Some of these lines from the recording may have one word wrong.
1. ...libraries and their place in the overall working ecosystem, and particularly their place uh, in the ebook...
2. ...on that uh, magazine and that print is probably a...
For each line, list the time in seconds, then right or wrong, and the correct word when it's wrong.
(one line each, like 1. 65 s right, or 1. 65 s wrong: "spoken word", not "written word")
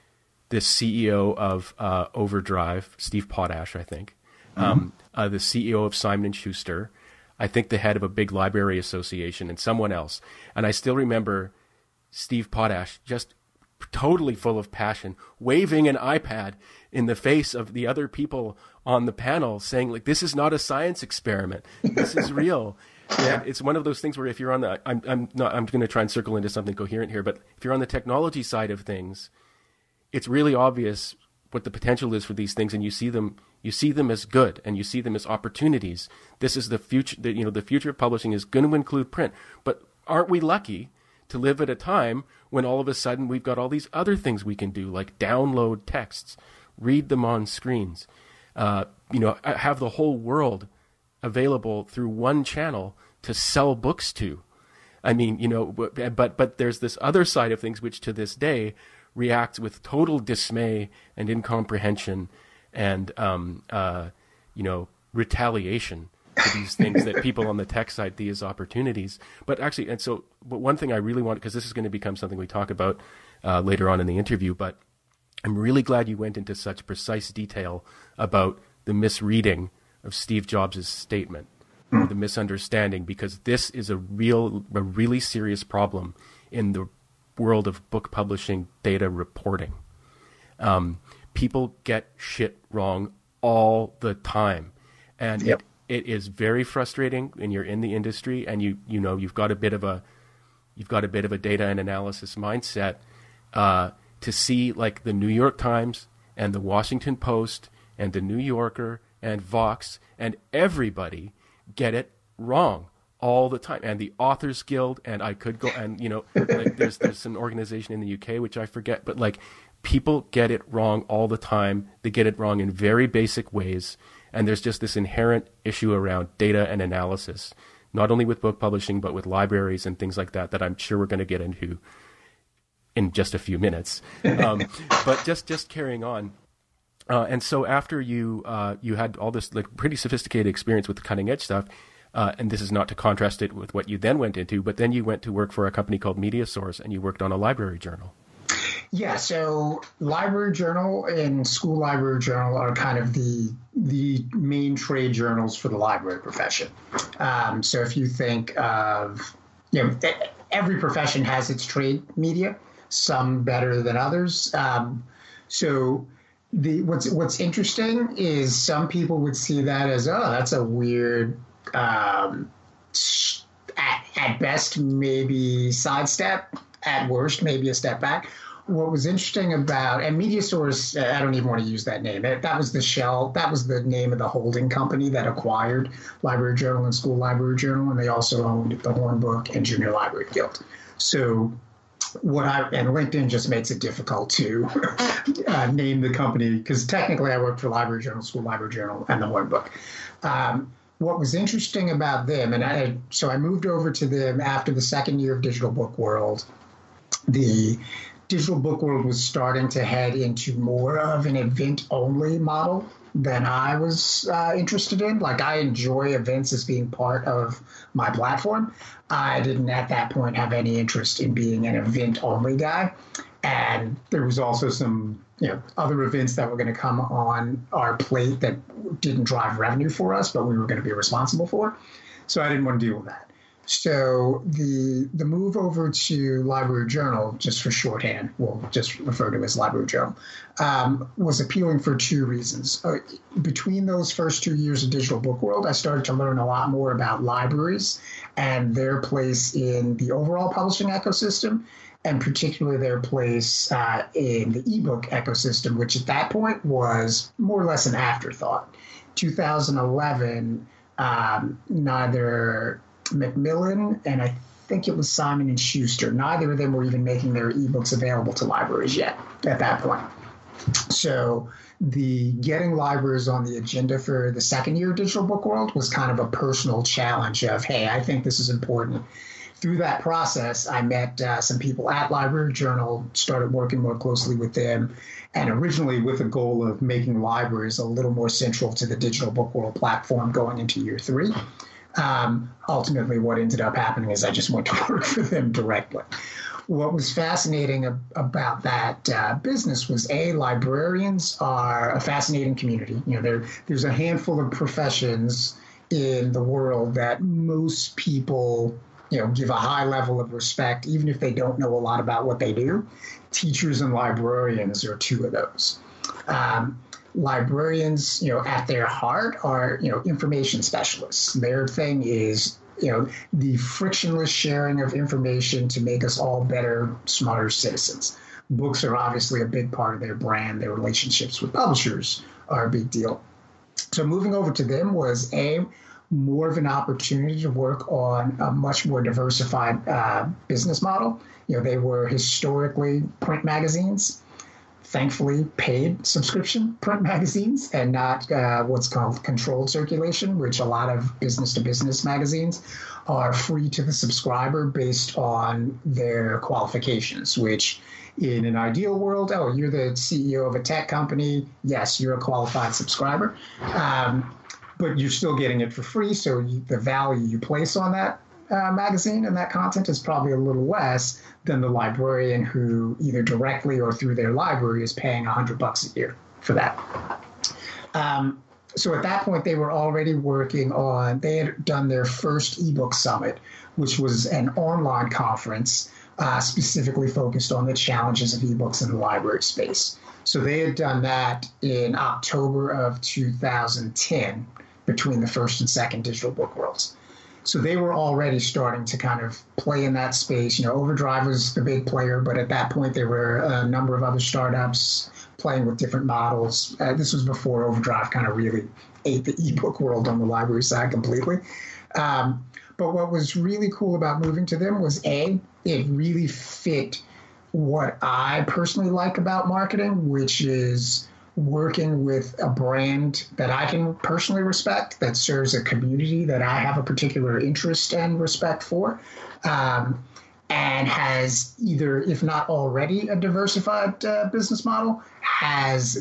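1. 247 s wrong: "publishing", not "working"
2. 367 s wrong: "content", not "print".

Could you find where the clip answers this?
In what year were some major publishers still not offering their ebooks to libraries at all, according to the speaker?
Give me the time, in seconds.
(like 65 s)
259 s.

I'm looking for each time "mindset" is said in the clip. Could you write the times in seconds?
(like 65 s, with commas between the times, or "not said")
102 s.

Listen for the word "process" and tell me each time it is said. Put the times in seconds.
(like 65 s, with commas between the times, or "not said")
280 s.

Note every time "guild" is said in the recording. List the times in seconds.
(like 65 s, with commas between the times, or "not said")
114 s, 190 s.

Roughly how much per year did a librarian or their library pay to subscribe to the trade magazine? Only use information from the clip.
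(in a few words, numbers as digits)
$100.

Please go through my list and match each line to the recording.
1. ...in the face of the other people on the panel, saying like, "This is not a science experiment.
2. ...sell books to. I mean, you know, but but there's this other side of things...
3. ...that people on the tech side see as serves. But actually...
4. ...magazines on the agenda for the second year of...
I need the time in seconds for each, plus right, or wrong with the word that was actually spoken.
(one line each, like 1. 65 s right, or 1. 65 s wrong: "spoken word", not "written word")
1. 16 s right
2. 53 s right
3. 67 s wrong: "opportunities", not "serves"
4. 272 s wrong: "libraries", not "magazines".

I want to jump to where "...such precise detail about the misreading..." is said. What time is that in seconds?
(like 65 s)
76 s.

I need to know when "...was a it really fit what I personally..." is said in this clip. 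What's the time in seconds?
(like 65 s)
414 s.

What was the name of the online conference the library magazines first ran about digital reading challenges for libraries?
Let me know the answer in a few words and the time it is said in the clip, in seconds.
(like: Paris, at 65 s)
ebook summit, at 382 s.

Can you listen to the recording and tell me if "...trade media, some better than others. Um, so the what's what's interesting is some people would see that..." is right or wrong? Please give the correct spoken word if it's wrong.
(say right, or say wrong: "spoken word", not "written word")
right.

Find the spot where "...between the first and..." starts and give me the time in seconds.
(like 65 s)
394 s.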